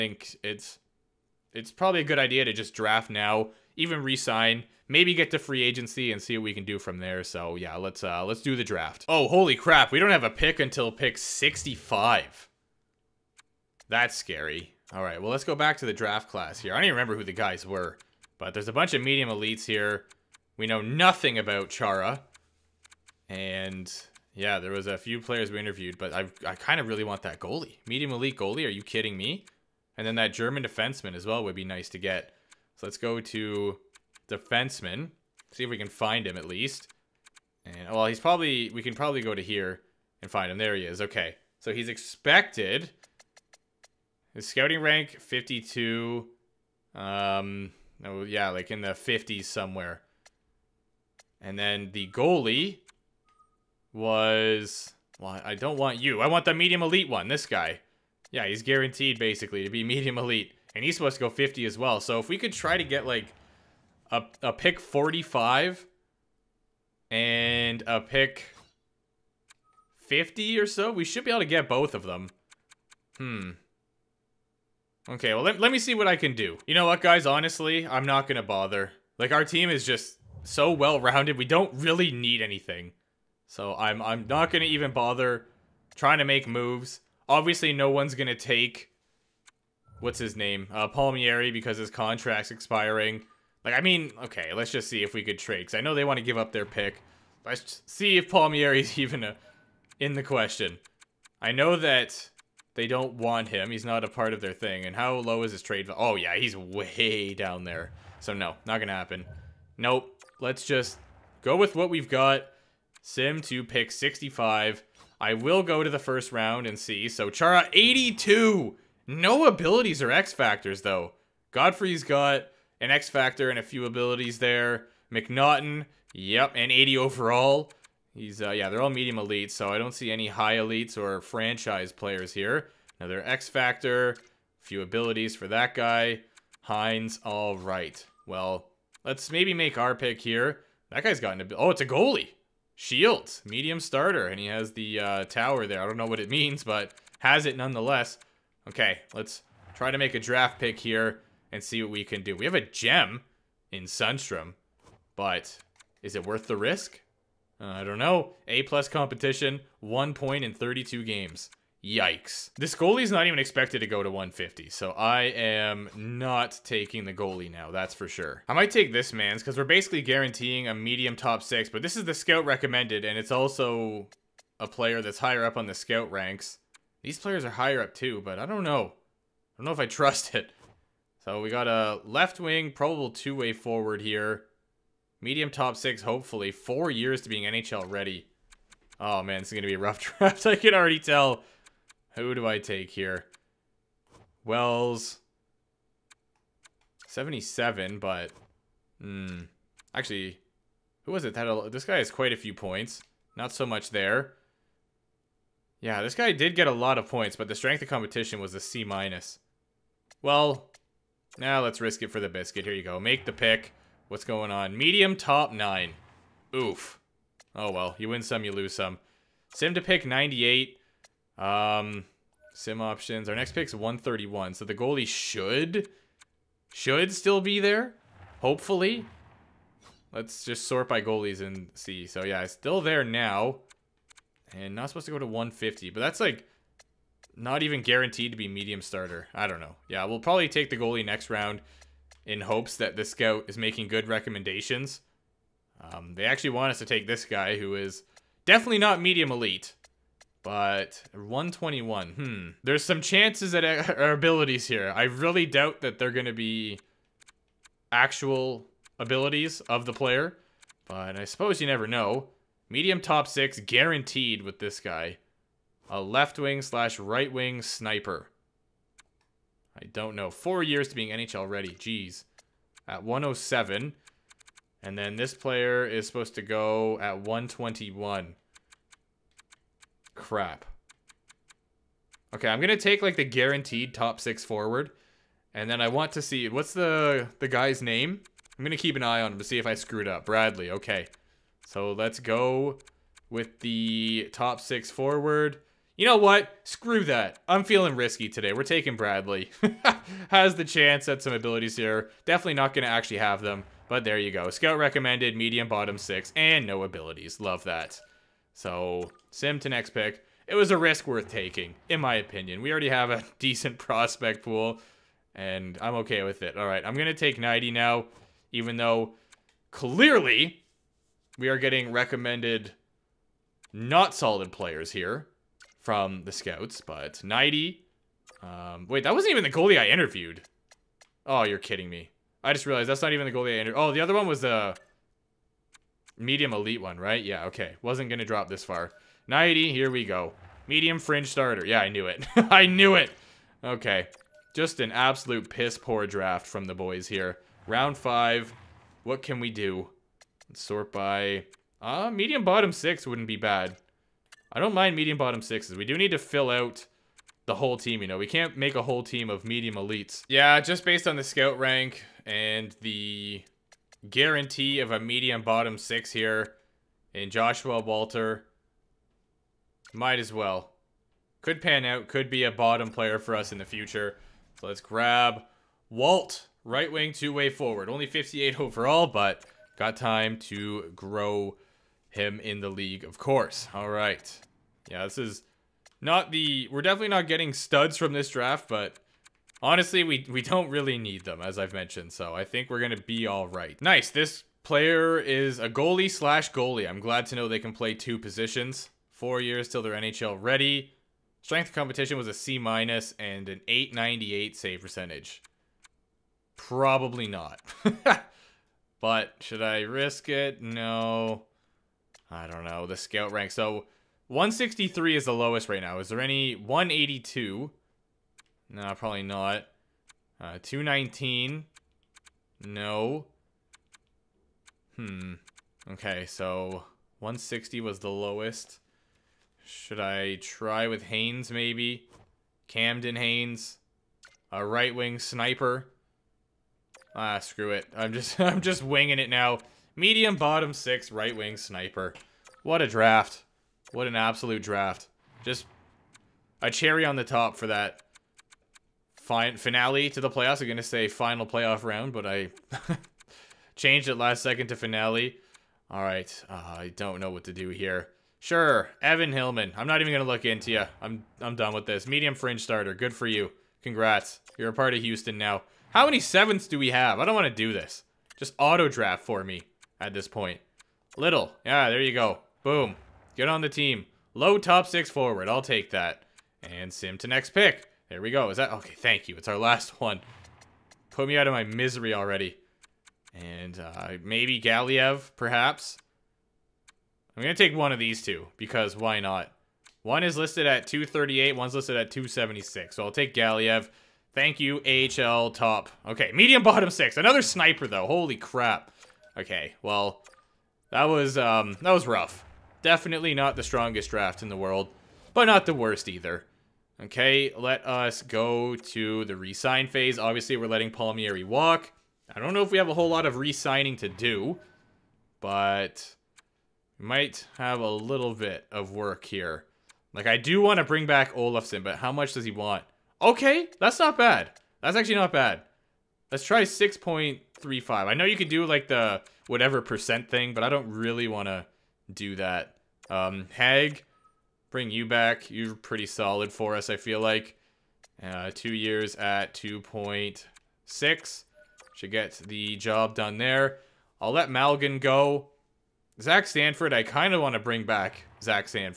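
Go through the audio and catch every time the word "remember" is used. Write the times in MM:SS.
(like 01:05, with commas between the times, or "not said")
00:16.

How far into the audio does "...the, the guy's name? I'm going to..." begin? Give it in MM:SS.
04:46.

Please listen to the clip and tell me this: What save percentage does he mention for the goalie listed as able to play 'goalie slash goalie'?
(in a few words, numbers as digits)
898.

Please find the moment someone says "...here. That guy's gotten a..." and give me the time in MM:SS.
02:20.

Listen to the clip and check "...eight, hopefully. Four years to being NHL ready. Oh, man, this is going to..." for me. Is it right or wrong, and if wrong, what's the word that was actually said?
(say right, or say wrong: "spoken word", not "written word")
wrong: "six", not "eight".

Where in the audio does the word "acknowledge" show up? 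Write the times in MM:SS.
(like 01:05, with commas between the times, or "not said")
not said.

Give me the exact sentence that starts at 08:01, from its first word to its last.
Put me out of my misery already.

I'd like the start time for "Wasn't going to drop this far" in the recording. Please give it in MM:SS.
05:37.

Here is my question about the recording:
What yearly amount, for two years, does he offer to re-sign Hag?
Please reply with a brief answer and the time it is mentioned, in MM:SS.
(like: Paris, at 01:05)
2.6, at 08:59.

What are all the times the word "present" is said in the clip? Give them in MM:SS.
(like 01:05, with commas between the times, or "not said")
not said.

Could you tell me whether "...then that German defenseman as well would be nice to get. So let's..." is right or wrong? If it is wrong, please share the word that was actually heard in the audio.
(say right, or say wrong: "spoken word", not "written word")
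right.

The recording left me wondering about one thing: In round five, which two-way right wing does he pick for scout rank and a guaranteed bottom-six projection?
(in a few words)
Joshua Walter.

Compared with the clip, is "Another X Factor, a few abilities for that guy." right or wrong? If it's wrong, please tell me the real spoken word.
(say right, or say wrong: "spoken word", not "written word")
right.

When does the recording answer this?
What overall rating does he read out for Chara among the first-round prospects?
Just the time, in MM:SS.
01:57.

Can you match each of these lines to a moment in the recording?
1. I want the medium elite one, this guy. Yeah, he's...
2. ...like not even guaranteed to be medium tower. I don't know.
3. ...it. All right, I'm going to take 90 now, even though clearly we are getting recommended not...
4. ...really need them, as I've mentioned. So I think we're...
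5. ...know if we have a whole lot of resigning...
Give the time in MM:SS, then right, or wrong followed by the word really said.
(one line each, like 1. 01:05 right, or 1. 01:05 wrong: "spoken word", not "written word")
1. 00:56 right
2. 03:56 wrong: "starter", not "tower"
3. 05:16 right
4. 06:30 right
5. 08:32 right.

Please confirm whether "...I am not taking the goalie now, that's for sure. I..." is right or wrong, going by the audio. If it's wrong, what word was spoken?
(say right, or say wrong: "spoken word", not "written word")
right.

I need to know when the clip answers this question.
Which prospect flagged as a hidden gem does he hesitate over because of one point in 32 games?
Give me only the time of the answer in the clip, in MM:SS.
02:33.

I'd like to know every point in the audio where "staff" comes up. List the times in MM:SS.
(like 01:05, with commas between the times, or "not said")
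not said.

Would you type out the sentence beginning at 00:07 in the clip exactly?
So yeah, let's uh, let's do the draft.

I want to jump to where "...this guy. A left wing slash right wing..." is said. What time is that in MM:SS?
04:24.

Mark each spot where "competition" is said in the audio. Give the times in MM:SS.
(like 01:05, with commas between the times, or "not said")
02:38, 03:27, 06:41.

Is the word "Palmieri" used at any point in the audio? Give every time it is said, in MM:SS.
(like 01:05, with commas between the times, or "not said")
01:30, 01:38, 08:30.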